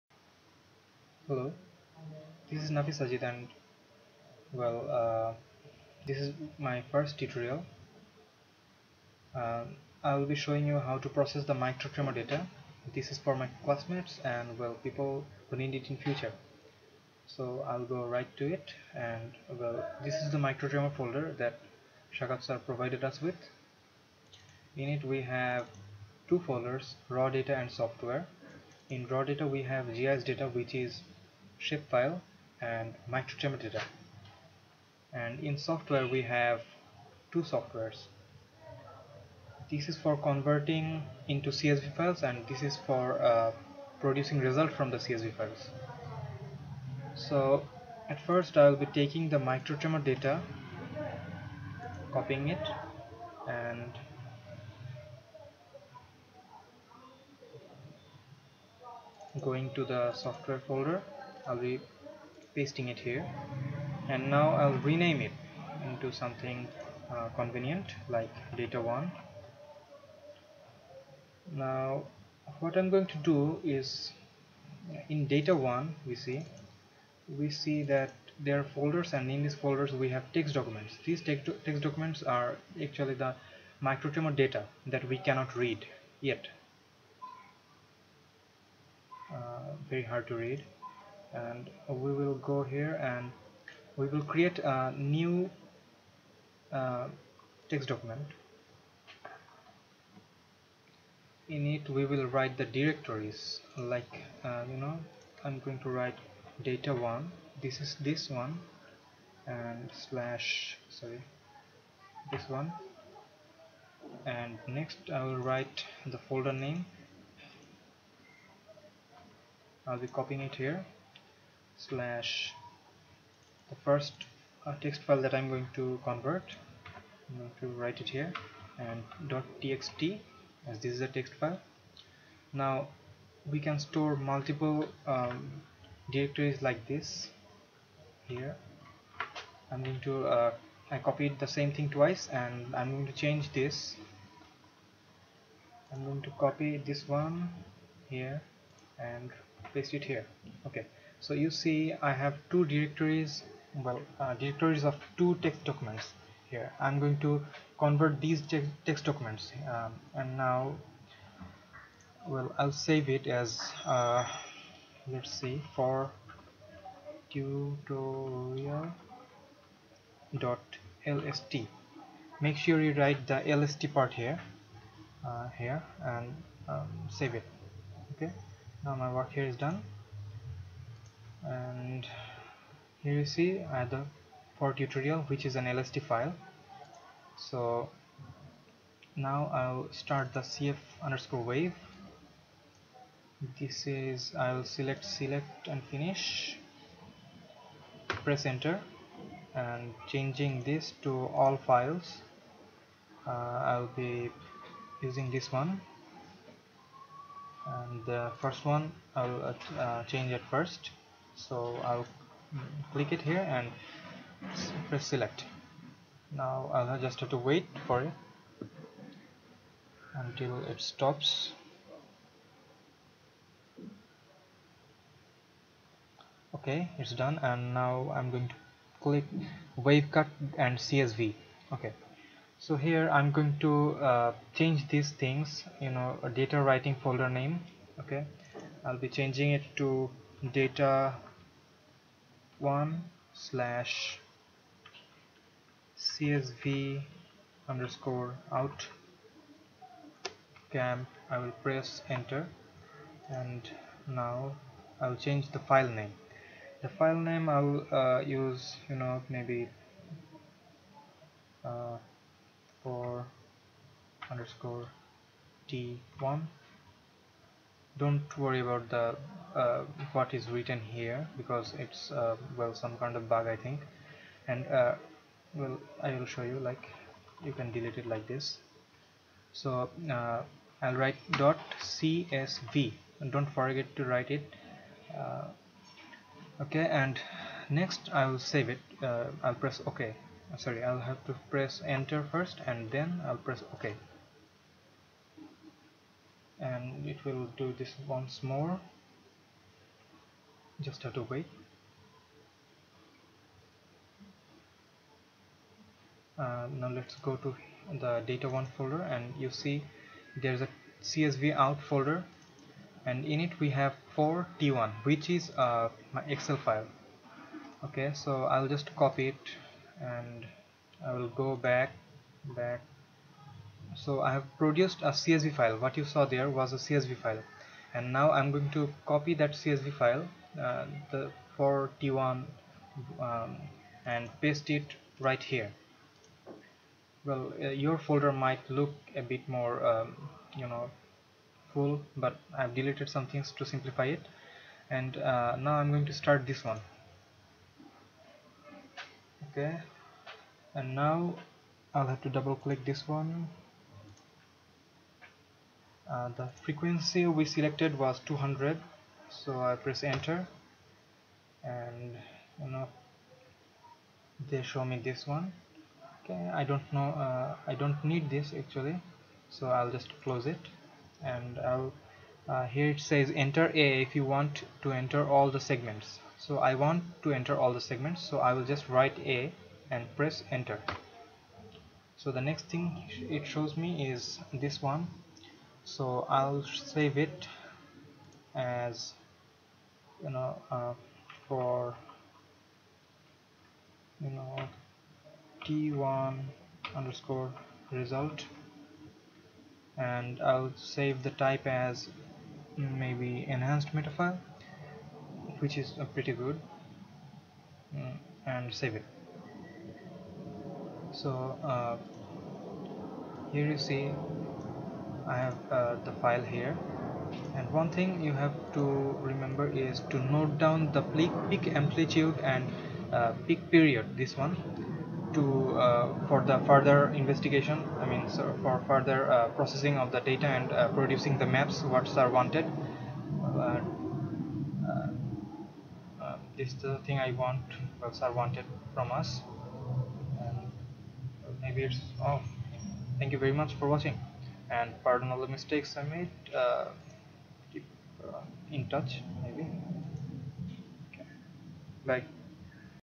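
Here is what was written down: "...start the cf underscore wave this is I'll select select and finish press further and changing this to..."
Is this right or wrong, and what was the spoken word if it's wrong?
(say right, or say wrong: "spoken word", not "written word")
wrong: "enter", not "further".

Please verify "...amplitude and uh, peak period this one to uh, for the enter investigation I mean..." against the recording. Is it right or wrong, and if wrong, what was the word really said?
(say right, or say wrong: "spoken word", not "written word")
wrong: "further", not "enter".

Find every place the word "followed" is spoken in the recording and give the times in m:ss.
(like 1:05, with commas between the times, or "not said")
not said.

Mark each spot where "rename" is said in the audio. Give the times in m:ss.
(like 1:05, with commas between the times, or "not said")
1:04.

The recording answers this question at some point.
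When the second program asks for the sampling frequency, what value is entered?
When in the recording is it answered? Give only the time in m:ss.
5:58.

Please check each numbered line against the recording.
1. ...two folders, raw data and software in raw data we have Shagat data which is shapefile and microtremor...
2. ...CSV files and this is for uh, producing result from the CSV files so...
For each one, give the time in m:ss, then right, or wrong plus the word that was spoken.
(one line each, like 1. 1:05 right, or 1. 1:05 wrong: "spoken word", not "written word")
1. 0:26 wrong: "GIS", not "Shagat"
2. 0:41 right.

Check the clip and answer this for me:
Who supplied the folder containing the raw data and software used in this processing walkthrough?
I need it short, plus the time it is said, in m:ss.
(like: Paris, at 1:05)
Shagat sir, at 0:22.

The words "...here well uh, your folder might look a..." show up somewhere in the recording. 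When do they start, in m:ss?
5:35.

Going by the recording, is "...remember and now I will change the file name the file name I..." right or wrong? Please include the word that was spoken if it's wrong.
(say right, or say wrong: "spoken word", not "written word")
wrong: "enter", not "remember".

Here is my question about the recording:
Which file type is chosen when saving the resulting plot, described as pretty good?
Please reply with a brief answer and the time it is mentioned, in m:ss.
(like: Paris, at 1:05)
enhanced metafile, at 6:43.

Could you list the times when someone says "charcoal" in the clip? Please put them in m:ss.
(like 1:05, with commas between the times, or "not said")
not said.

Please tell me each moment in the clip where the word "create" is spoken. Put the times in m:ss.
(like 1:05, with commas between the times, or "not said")
1:34.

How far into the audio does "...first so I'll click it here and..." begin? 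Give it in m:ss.
3:30.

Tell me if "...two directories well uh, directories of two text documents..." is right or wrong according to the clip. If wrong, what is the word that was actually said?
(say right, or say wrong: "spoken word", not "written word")
right.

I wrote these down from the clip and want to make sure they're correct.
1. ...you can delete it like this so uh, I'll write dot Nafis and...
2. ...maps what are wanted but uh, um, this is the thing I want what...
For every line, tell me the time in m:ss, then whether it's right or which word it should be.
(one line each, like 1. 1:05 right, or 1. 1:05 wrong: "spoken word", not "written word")
1. 4:37 wrong: "CSV", not "Nafis"
2. 7:11 right.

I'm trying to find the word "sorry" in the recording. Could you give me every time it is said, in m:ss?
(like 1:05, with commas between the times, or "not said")
1:50, 4:50.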